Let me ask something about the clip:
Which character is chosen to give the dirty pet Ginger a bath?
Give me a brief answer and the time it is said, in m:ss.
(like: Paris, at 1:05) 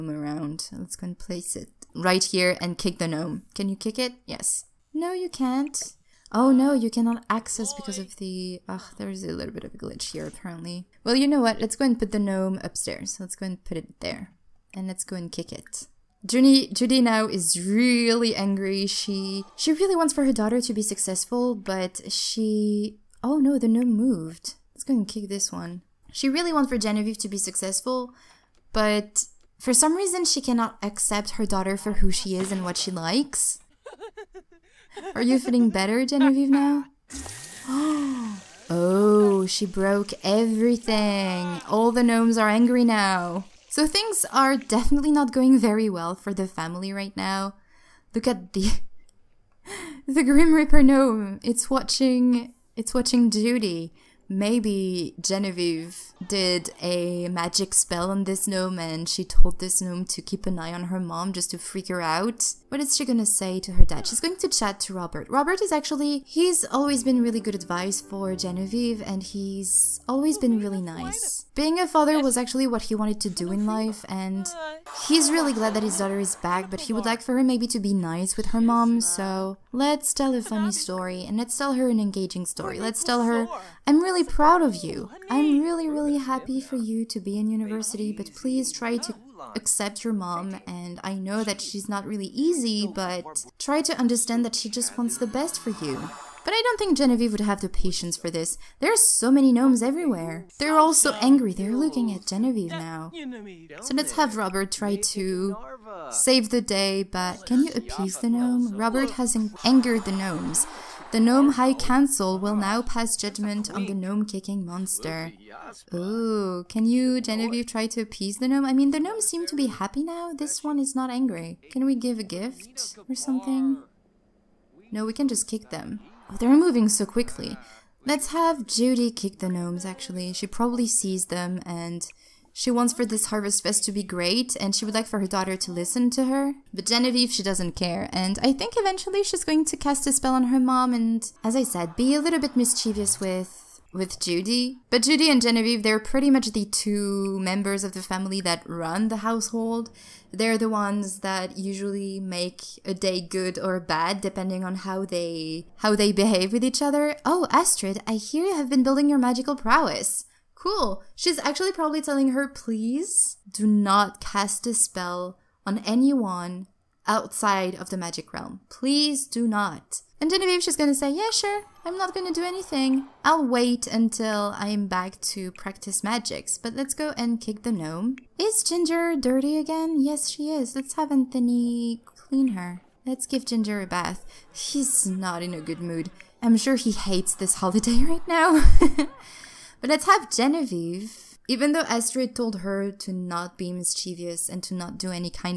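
Anthony, at 3:01.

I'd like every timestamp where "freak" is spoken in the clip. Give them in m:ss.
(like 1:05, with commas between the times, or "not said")
1:01.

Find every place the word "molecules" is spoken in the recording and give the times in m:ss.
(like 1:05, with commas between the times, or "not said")
not said.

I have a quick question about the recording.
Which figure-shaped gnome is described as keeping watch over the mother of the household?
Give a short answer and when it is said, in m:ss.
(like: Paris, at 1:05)
Grim Reaper gnome, at 0:50.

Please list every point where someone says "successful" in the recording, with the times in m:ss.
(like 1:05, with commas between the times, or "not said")
0:20, 0:27.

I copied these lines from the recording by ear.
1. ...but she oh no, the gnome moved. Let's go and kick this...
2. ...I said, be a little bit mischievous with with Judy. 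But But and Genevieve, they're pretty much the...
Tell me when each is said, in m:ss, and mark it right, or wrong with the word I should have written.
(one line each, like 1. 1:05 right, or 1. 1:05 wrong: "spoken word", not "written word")
1. 0:21 right
2. 2:21 wrong: "Judy", not "But".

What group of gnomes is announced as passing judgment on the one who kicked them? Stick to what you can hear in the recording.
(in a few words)
Gnome High Council.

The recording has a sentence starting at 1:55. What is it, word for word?
Ooh, can you, Genevieve, try to appease the gnome?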